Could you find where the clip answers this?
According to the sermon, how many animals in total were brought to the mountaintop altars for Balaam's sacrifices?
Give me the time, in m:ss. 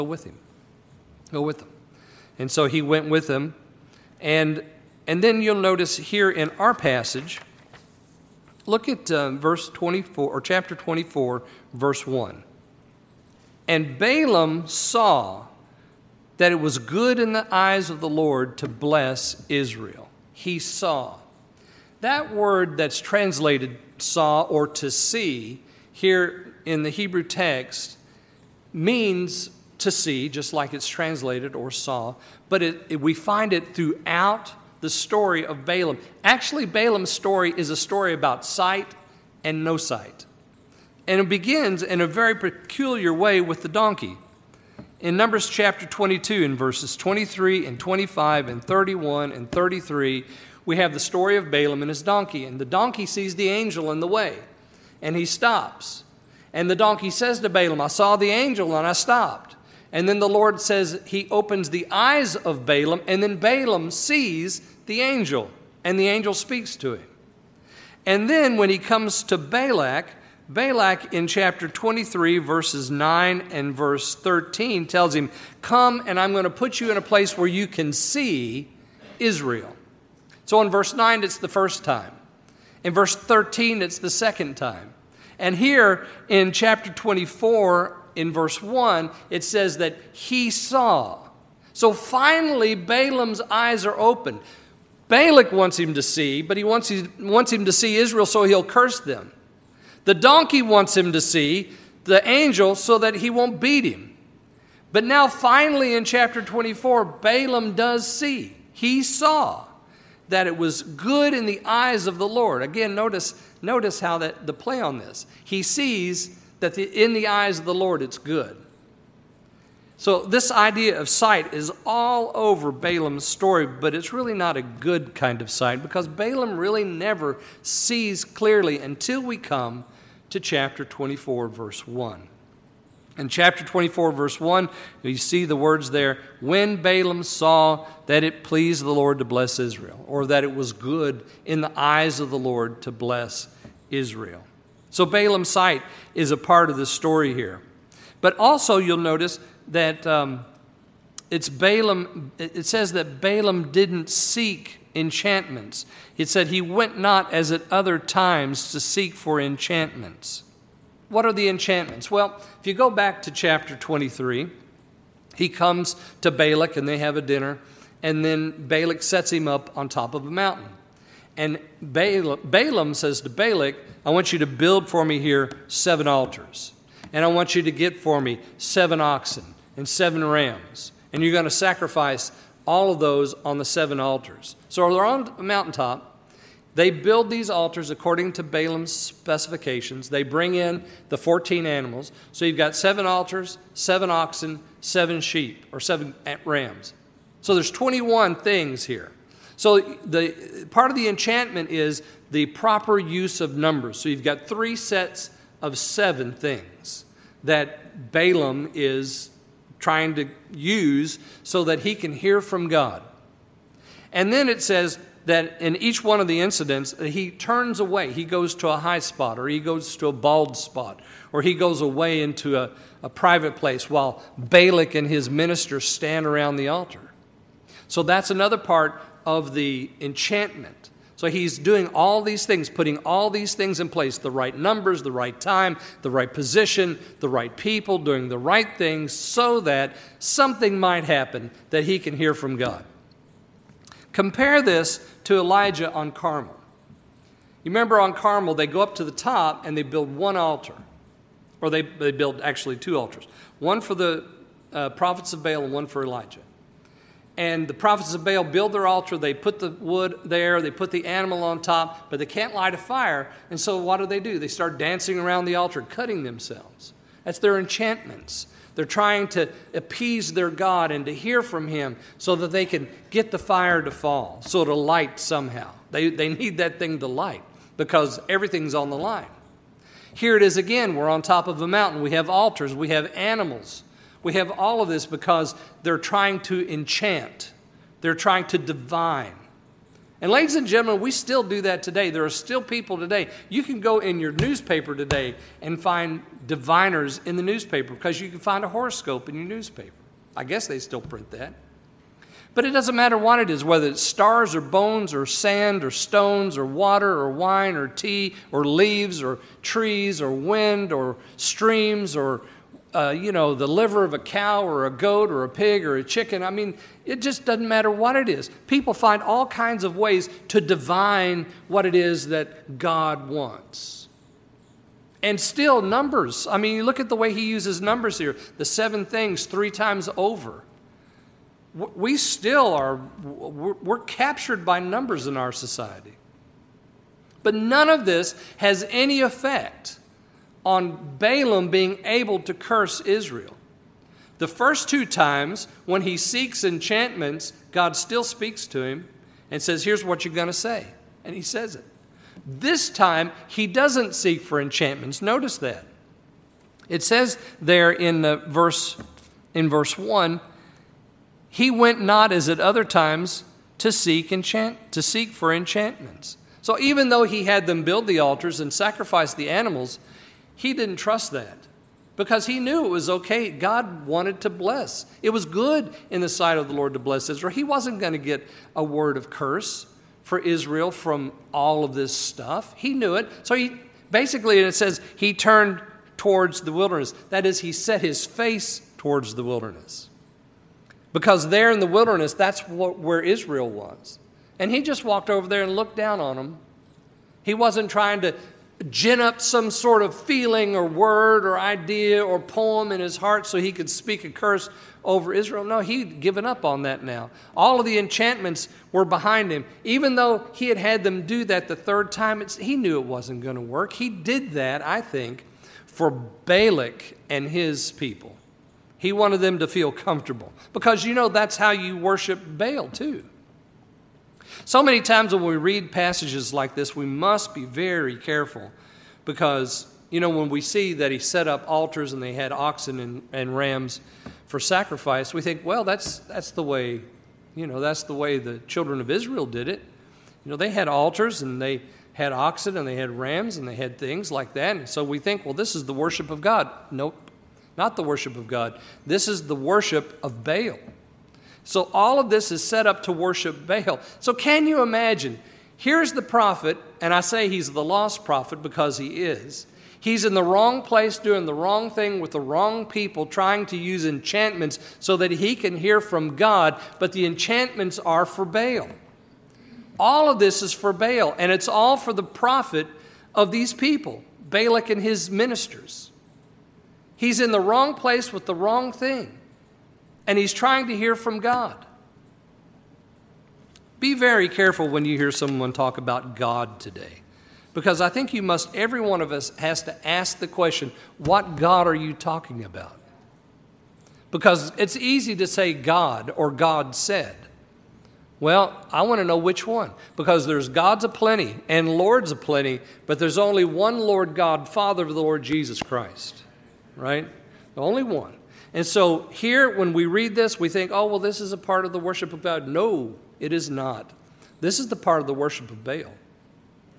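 3:11.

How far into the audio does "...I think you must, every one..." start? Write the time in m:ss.
8:08.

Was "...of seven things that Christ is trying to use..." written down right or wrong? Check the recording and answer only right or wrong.
wrong.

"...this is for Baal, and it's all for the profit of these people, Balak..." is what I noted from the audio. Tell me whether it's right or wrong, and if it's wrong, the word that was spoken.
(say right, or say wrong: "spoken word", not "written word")
right.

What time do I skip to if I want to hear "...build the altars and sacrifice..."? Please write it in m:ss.
6:07.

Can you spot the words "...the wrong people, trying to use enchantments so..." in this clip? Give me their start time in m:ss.
7:42.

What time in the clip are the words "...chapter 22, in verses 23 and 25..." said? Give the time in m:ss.
0:45.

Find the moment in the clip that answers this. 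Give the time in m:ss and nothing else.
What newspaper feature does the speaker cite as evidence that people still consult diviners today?
4:58.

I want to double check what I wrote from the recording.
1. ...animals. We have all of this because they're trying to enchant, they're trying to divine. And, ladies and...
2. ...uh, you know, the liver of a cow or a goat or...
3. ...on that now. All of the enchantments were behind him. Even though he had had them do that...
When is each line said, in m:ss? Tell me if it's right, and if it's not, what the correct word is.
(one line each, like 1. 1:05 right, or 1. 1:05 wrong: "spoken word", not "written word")
1. 4:43 right
2. 5:12 right
3. 6:46 right.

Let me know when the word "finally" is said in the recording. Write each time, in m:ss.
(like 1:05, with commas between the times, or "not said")
1:31, 1:45.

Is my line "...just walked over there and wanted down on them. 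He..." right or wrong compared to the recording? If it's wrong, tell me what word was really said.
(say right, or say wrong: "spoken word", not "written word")
wrong: "looked", not "wanted".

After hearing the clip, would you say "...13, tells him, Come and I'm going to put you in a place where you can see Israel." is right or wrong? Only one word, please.
right.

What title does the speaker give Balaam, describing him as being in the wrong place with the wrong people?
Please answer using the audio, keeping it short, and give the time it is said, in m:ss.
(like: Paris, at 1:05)
The lost prophet, at 7:37.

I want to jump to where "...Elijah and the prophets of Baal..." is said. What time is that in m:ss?
4:16.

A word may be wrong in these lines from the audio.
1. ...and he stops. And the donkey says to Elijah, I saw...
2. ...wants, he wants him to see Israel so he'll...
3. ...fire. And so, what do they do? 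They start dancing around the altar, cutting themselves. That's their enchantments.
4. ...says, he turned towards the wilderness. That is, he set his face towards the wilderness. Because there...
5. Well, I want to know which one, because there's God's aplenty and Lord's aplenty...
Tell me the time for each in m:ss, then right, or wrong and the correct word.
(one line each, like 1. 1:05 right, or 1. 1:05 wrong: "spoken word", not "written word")
1. 0:55 wrong: "Balaam", not "Elijah"
2. 1:36 right
3. 4:22 right
4. 6:24 right
5. 8:18 right.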